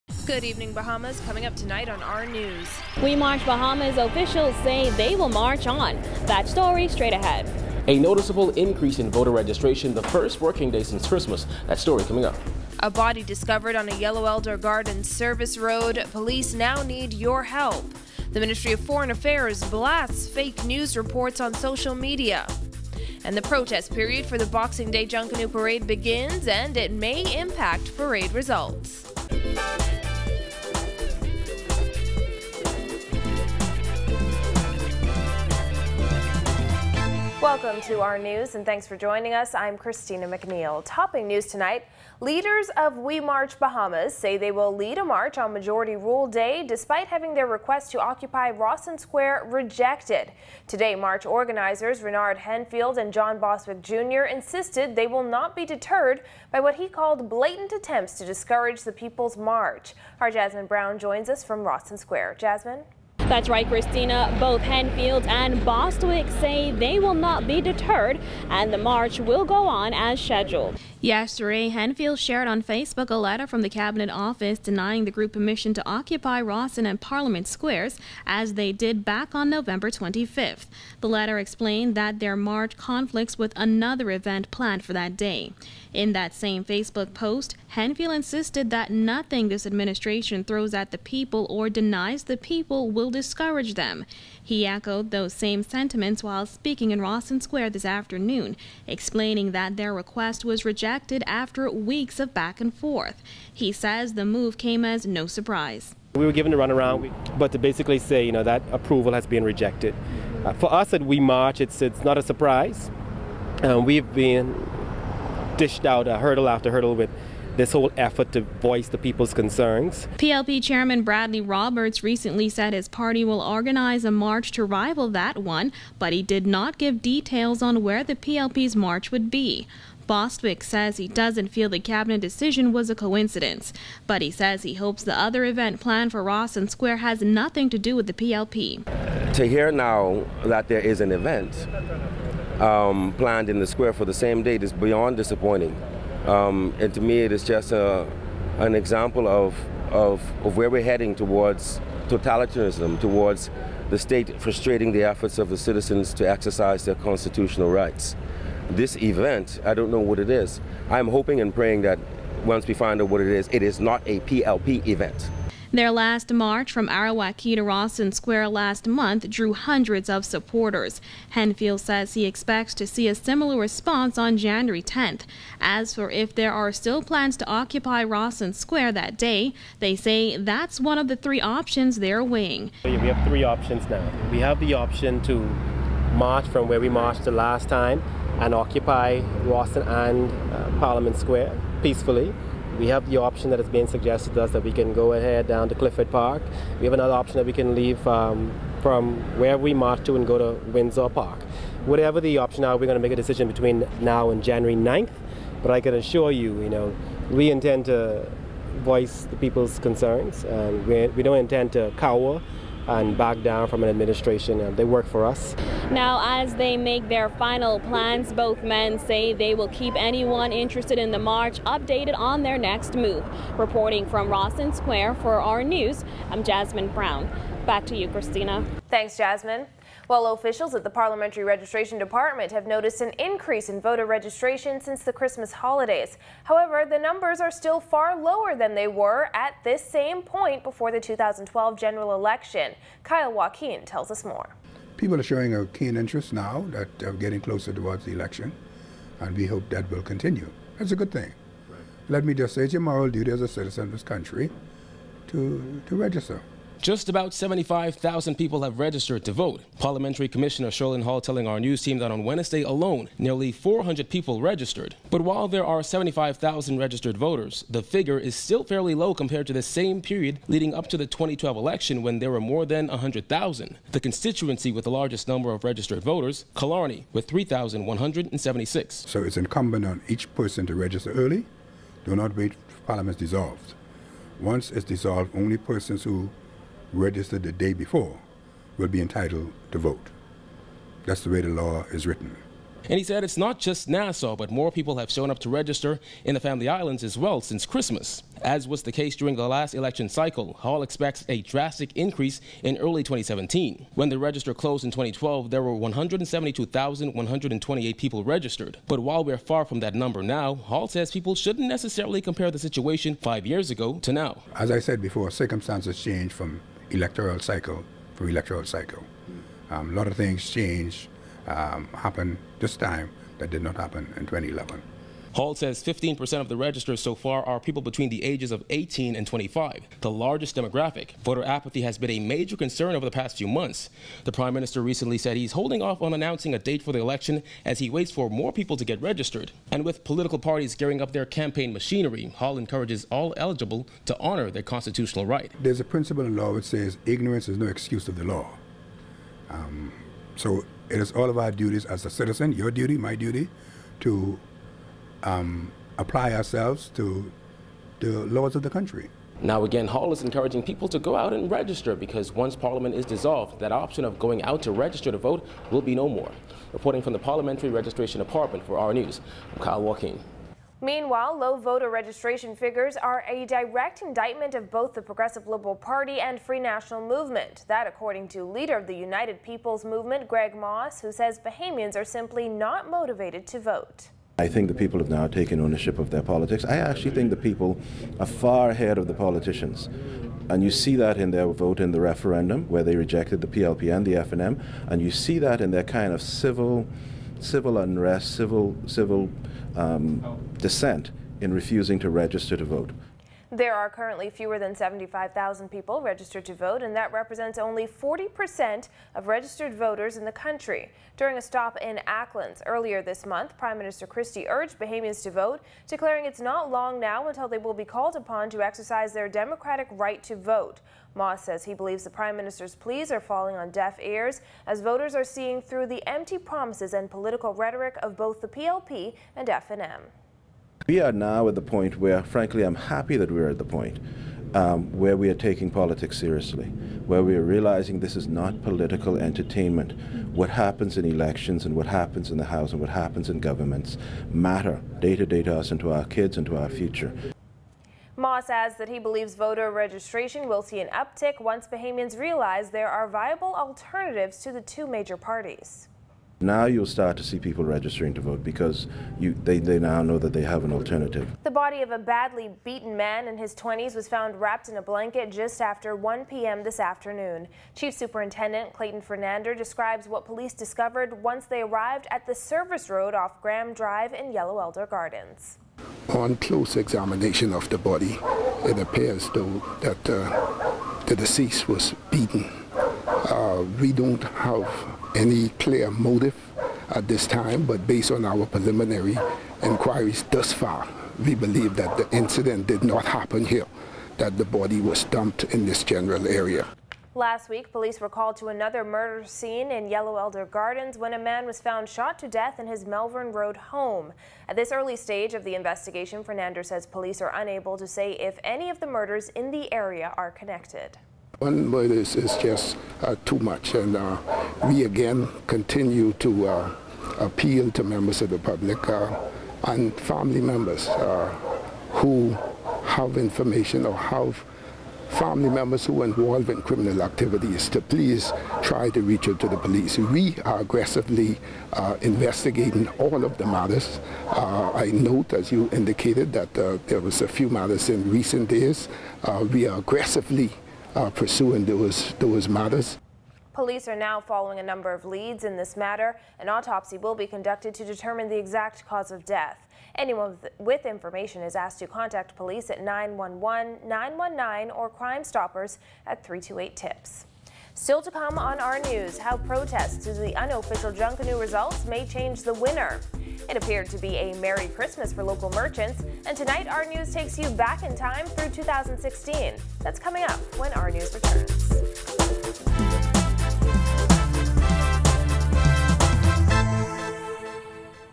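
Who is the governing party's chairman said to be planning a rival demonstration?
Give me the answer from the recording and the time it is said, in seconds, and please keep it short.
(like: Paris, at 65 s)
Bradley Roberts, at 121 s.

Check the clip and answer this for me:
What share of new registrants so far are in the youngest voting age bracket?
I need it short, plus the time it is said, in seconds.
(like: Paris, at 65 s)
15%, at 325 s.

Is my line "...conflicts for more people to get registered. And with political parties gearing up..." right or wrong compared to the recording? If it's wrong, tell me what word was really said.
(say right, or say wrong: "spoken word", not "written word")
wrong: "waits", not "conflicts".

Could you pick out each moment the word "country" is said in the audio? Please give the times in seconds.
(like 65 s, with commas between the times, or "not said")
254 s, 358 s, 410 s.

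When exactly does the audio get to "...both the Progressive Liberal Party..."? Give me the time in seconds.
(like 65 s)
374 s.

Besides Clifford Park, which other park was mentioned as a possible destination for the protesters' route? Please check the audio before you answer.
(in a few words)
Windsor Park.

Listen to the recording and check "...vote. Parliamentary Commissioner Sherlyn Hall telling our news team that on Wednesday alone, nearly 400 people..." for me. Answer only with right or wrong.
right.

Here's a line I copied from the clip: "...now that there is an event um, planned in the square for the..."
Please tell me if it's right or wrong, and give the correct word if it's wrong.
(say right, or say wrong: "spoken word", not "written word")
right.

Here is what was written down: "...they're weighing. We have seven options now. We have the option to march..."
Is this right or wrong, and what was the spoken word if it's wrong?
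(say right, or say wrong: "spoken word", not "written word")
wrong: "three", not "seven".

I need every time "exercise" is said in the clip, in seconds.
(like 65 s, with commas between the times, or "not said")
156 s, 418 s.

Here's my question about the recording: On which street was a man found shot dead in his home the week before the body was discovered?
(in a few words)
Melvern Road.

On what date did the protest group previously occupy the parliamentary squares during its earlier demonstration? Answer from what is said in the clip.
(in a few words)
November 25th.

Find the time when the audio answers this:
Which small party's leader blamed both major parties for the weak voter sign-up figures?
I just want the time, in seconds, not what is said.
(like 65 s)
378 s.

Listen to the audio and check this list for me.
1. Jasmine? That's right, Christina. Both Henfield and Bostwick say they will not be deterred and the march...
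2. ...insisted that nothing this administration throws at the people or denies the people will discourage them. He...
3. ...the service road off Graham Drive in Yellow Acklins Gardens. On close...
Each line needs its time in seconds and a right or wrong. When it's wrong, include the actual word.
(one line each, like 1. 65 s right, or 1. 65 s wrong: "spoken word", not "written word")
1. 62 s right
2. 88 s right
3. 472 s wrong: "Elder", not "Acklins".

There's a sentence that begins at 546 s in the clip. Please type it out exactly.
An autopsy will be conducted to determine the exact cause of death.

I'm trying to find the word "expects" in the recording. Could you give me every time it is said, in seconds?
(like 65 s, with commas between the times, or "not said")
172 s, 300 s.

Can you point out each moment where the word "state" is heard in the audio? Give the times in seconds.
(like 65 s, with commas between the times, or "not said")
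153 s.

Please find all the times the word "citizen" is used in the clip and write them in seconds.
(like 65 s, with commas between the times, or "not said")
155 s, 253 s, 352 s.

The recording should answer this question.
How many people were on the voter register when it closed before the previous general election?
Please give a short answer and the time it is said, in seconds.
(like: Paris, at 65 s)
172,128, at 305 s.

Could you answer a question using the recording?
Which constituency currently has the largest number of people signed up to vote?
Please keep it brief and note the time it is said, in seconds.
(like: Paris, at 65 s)
Killarney, at 276 s.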